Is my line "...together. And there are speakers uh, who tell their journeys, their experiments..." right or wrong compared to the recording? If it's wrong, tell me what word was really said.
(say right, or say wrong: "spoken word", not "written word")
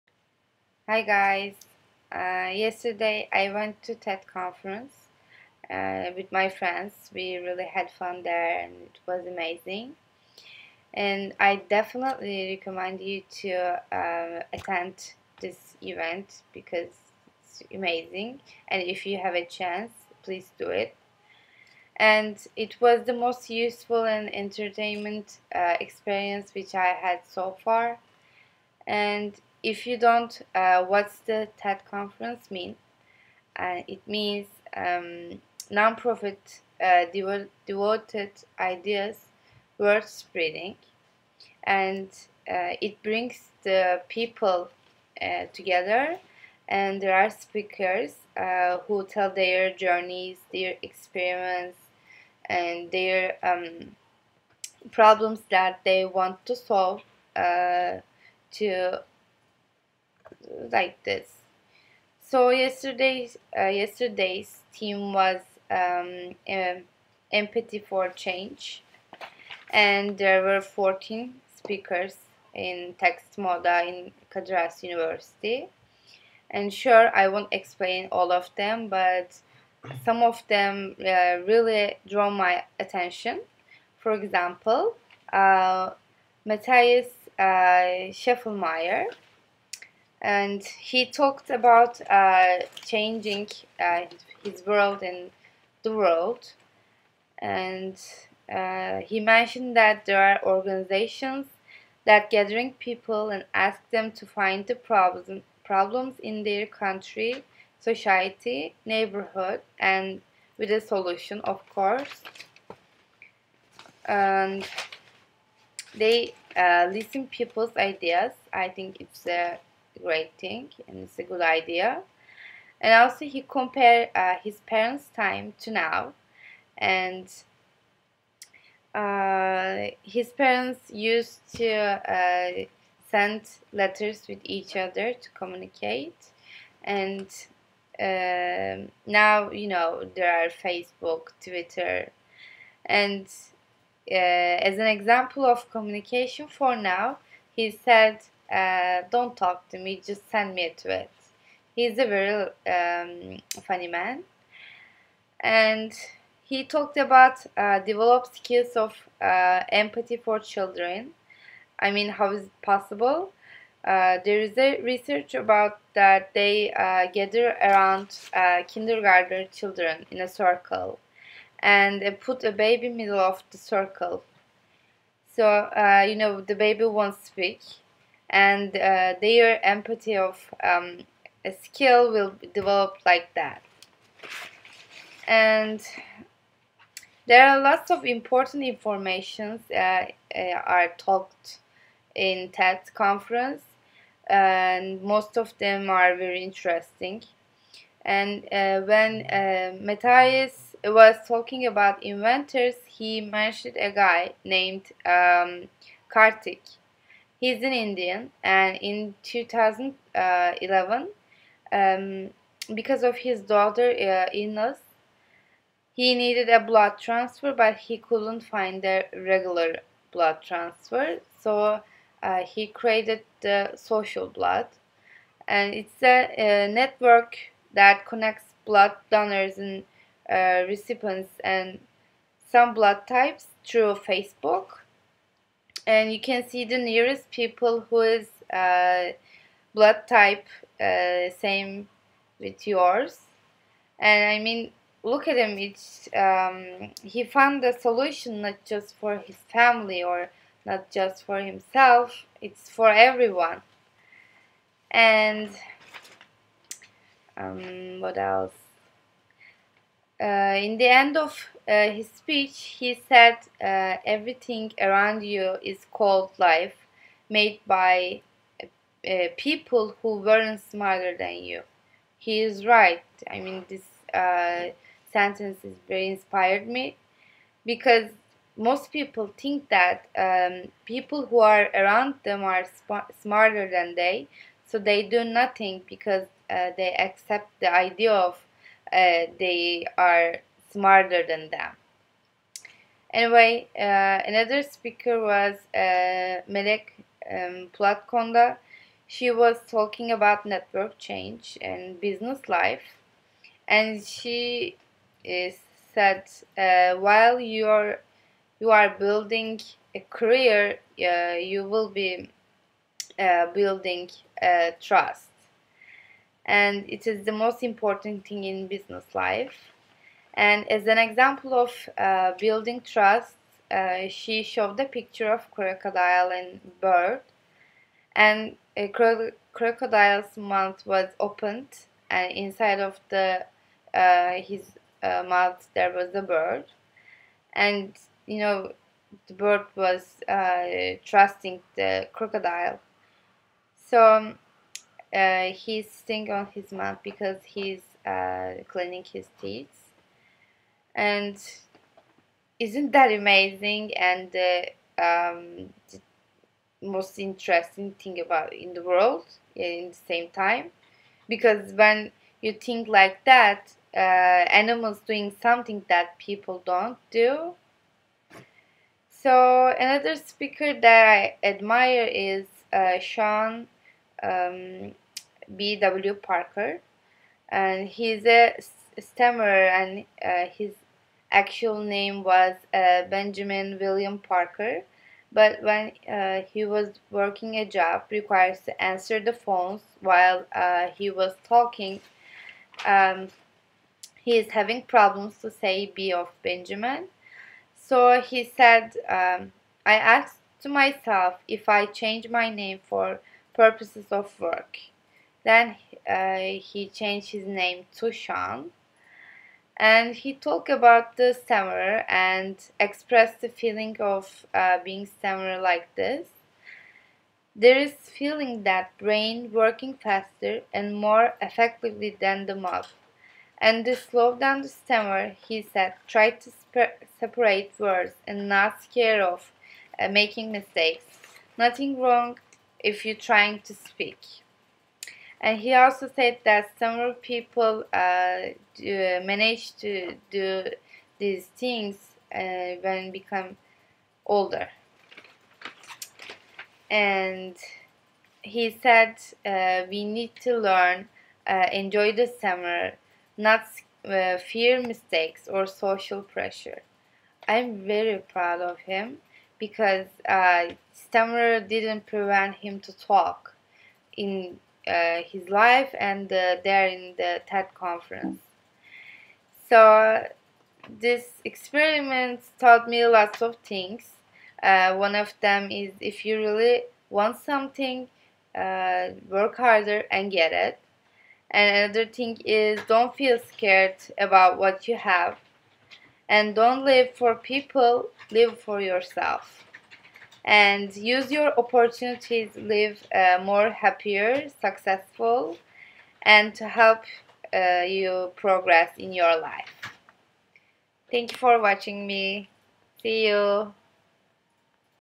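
right.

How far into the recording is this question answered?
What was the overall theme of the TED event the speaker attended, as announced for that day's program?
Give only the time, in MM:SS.
01:07.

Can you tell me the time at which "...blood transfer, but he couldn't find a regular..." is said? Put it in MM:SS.
03:36.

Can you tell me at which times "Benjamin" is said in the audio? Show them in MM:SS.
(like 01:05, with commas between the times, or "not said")
06:23, 06:36.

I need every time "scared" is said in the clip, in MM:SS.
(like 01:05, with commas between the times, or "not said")
07:08, 08:03.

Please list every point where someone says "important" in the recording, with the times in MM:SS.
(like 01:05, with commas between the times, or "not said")
03:08, 05:17.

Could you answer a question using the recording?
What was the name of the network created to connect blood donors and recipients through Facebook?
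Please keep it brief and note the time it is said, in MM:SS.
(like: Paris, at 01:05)
Social Blood, at 03:43.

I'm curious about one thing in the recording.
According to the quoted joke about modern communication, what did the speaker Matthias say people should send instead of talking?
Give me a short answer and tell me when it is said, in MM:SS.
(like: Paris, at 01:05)
A tweet, at 02:30.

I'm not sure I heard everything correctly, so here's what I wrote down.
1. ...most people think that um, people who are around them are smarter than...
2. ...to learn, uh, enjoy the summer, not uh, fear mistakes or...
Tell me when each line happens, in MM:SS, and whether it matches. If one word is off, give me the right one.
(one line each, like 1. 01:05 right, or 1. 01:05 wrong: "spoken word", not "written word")
1. 04:38 right
2. 07:30 right.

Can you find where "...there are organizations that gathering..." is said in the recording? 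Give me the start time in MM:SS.
01:40.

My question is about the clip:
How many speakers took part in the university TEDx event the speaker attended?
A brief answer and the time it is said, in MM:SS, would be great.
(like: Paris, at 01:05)
14, at 01:10.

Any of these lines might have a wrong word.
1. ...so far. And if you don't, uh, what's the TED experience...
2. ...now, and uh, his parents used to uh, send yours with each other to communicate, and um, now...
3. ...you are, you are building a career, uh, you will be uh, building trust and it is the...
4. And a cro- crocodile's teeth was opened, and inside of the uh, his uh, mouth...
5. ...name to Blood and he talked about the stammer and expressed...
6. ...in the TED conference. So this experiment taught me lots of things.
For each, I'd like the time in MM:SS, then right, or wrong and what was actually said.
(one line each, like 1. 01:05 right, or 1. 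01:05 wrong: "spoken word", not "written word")
1. 00:27 wrong: "conference", not "experience"
2. 02:05 wrong: "letters", not "yours"
3. 05:07 right
4. 05:28 wrong: "mouth", not "teeth"
5. 06:47 wrong: "Sean", not "Blood"
6. 07:46 right.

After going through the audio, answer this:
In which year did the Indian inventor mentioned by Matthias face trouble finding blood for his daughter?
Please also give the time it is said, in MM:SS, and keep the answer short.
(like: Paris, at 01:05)
2011, at 03:29.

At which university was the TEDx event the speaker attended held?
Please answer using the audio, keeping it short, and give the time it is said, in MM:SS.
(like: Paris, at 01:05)
Kadir Has University, at 01:14.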